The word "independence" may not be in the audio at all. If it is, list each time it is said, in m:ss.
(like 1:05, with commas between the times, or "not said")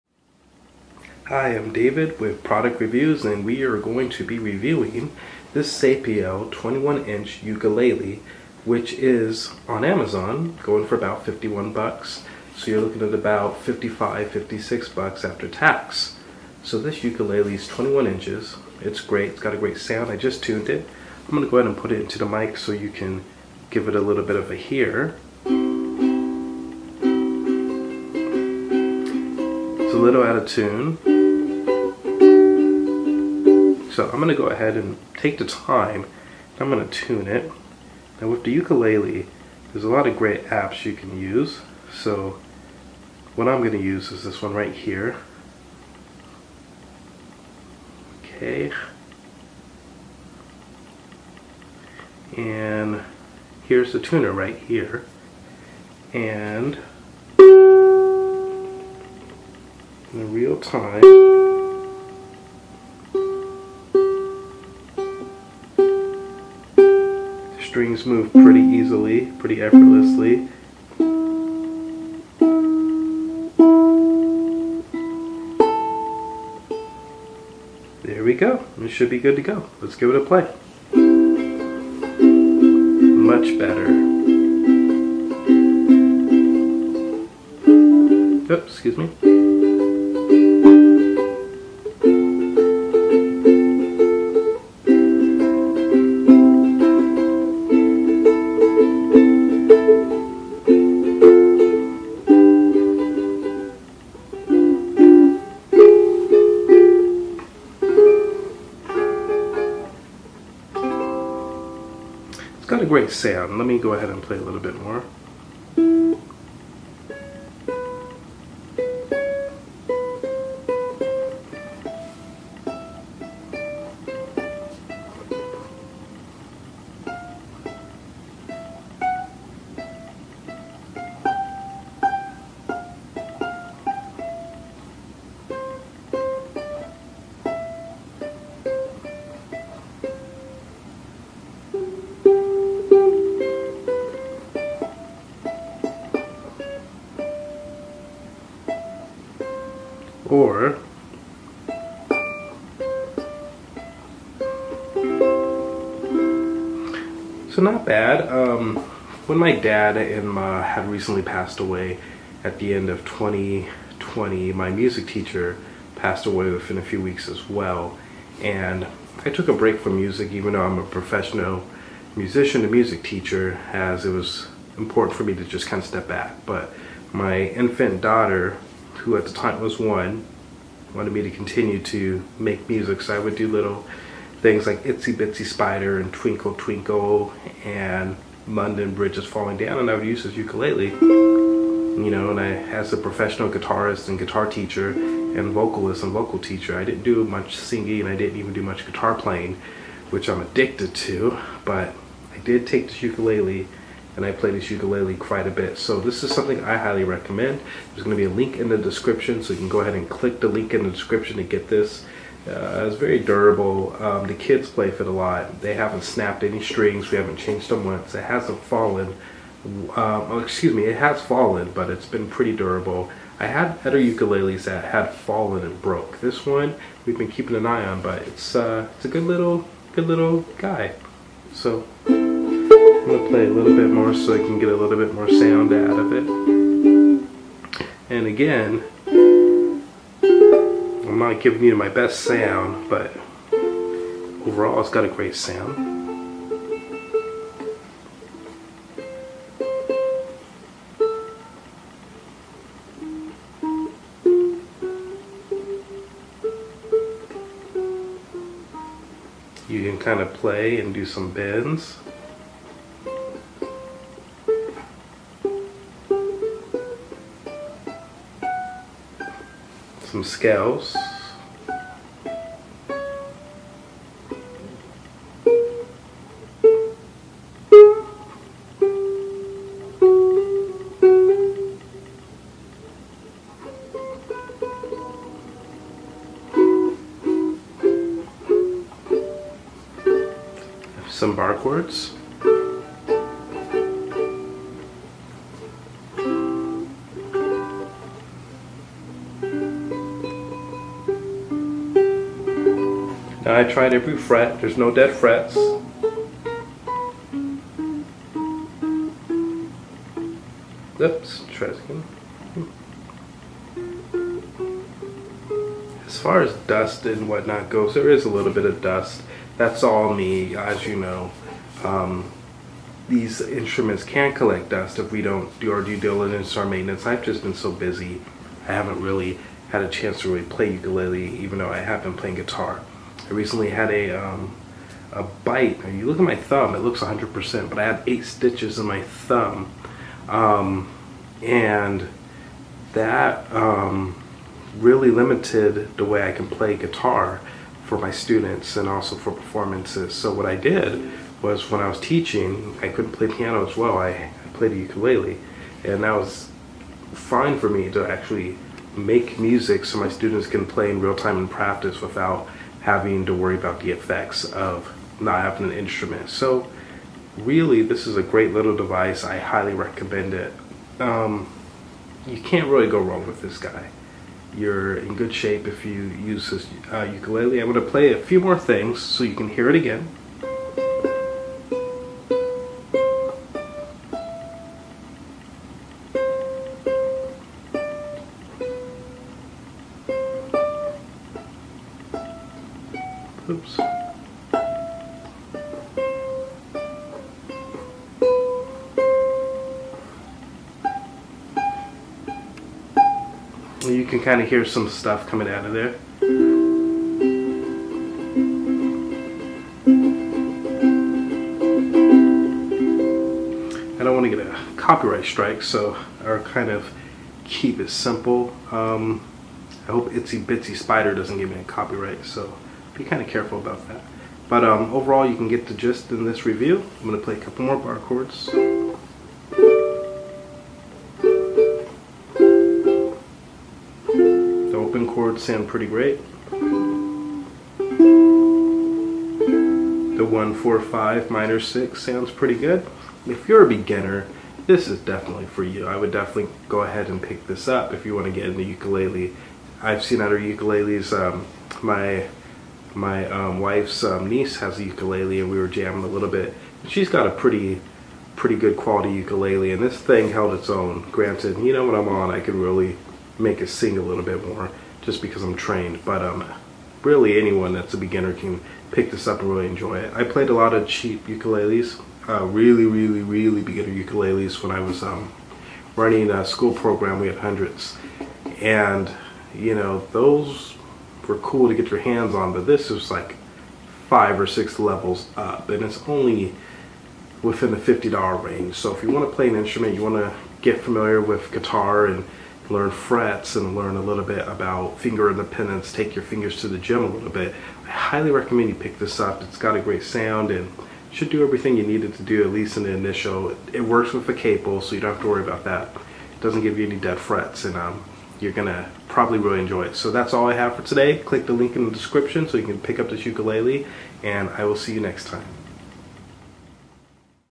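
8:15.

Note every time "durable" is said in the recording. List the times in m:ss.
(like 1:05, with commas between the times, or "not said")
3:33, 3:42.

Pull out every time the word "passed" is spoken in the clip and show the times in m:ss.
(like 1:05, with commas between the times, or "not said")
2:41, 2:45.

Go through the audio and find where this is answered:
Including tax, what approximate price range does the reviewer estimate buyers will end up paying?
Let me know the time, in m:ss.
0:13.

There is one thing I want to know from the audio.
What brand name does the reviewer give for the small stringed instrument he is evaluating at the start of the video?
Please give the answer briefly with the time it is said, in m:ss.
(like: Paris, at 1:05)
Sapio, at 0:05.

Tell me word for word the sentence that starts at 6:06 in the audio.
So really, this is a great little device.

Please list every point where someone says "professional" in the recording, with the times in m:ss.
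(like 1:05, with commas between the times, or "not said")
2:50, 3:12.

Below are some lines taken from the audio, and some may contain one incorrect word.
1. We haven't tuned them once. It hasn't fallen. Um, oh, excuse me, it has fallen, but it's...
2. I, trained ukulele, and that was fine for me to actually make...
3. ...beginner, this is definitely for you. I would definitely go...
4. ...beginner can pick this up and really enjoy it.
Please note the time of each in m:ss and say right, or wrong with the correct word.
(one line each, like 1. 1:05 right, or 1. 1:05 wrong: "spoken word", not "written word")
1. 3:37 wrong: "changed", not "tuned"
2. 5:53 wrong: "played", not "trained"
3. 7:23 right
4. 7:47 right.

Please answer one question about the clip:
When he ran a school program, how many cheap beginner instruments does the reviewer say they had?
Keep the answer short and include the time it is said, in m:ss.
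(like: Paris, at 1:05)
Hundreds, at 7:57.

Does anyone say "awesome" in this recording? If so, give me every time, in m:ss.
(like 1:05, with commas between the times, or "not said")
not said.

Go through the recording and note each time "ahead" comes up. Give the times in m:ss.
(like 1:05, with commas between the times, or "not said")
0:21, 0:34, 1:53, 3:29, 7:26.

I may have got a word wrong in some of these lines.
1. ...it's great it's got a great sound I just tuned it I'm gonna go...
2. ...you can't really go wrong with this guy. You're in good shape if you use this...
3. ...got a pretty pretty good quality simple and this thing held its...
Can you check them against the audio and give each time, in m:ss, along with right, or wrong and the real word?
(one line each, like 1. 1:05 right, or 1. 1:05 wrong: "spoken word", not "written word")
1. 0:18 right
2. 6:12 right
3. 7:37 wrong: "ukulele", not "simple".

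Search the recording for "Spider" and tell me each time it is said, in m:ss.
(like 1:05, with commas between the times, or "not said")
3:05, 7:00.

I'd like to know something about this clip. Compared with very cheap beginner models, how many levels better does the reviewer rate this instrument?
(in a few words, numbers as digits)
5 or 6.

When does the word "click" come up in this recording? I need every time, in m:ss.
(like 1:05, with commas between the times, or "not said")
3:30, 8:31.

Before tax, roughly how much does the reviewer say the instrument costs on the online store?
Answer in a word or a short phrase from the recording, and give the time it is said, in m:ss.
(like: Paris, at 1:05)
$51, at 0:11.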